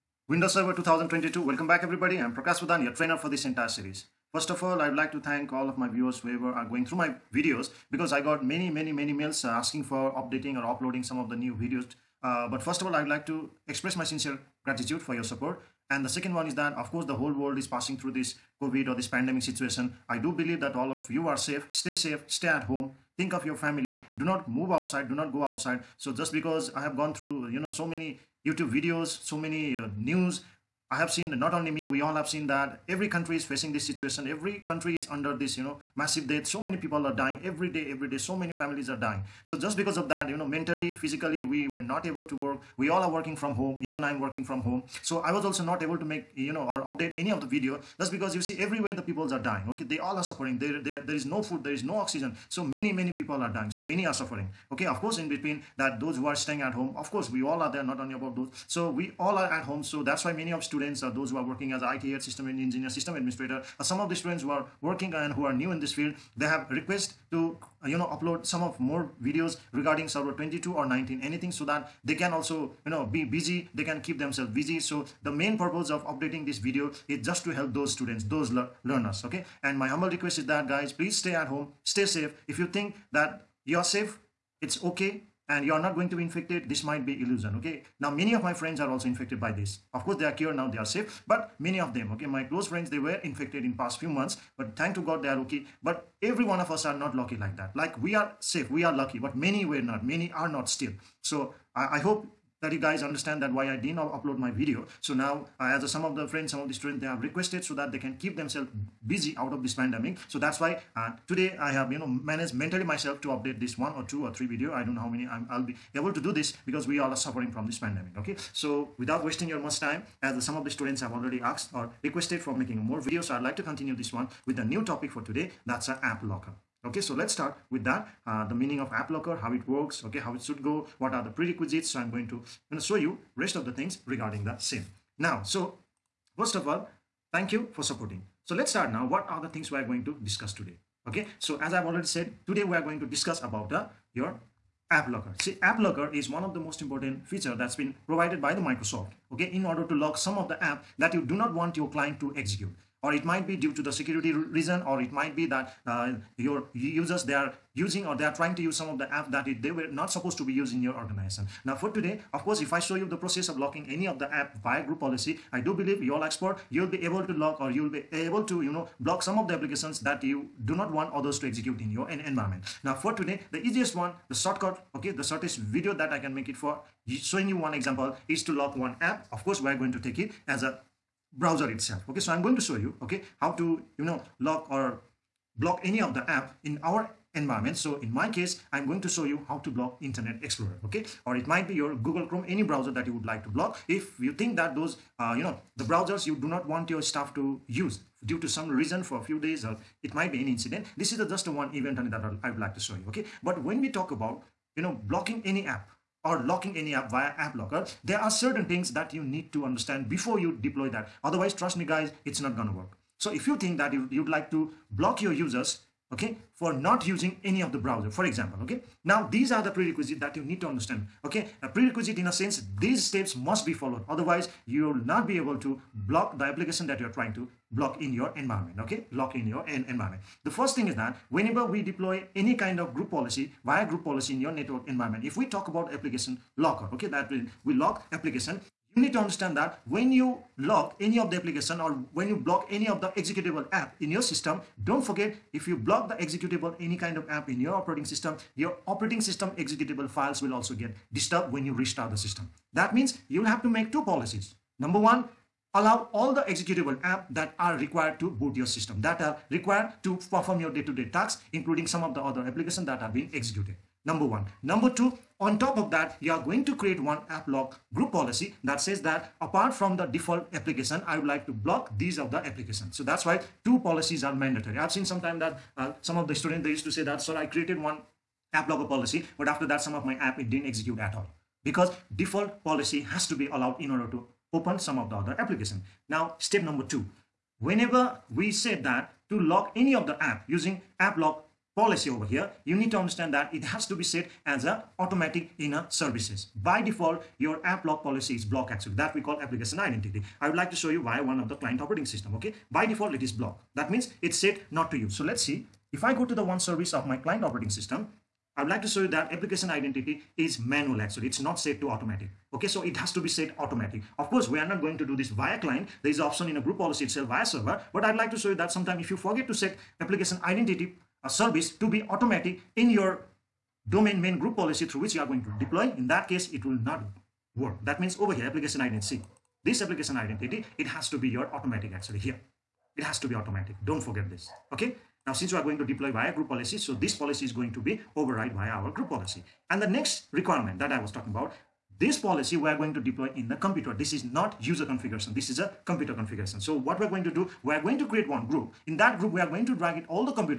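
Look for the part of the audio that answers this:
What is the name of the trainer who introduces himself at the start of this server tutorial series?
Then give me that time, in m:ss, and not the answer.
0:02.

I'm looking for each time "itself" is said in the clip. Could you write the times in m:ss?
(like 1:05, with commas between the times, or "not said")
3:01, 5:17.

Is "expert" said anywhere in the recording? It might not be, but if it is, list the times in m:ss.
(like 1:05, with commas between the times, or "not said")
2:46.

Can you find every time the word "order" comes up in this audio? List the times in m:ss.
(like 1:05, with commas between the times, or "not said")
2:29, 4:43.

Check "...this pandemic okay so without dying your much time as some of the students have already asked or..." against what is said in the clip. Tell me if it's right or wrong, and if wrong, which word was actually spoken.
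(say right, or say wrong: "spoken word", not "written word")
wrong: "wasting", not "dying".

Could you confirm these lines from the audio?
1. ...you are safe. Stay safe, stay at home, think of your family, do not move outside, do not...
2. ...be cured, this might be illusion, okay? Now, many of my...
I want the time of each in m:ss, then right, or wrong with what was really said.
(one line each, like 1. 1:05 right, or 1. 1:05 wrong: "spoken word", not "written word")
1. 0:21 right
2. 1:26 wrong: "infected", not "cured".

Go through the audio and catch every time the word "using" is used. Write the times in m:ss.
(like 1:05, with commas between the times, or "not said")
2:37, 3:37, 4:50.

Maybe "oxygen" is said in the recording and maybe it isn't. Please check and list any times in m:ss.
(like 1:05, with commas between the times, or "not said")
0:51.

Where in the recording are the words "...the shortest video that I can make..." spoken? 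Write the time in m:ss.
2:55.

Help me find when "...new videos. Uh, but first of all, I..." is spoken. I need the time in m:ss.
0:11.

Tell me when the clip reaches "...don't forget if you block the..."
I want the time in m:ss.
4:04.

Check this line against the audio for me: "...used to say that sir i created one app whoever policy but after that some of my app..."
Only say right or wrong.
wrong.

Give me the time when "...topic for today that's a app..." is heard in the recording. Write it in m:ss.
2:04.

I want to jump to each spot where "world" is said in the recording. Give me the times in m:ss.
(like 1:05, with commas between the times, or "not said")
0:17.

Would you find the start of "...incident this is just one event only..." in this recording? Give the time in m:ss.
3:20.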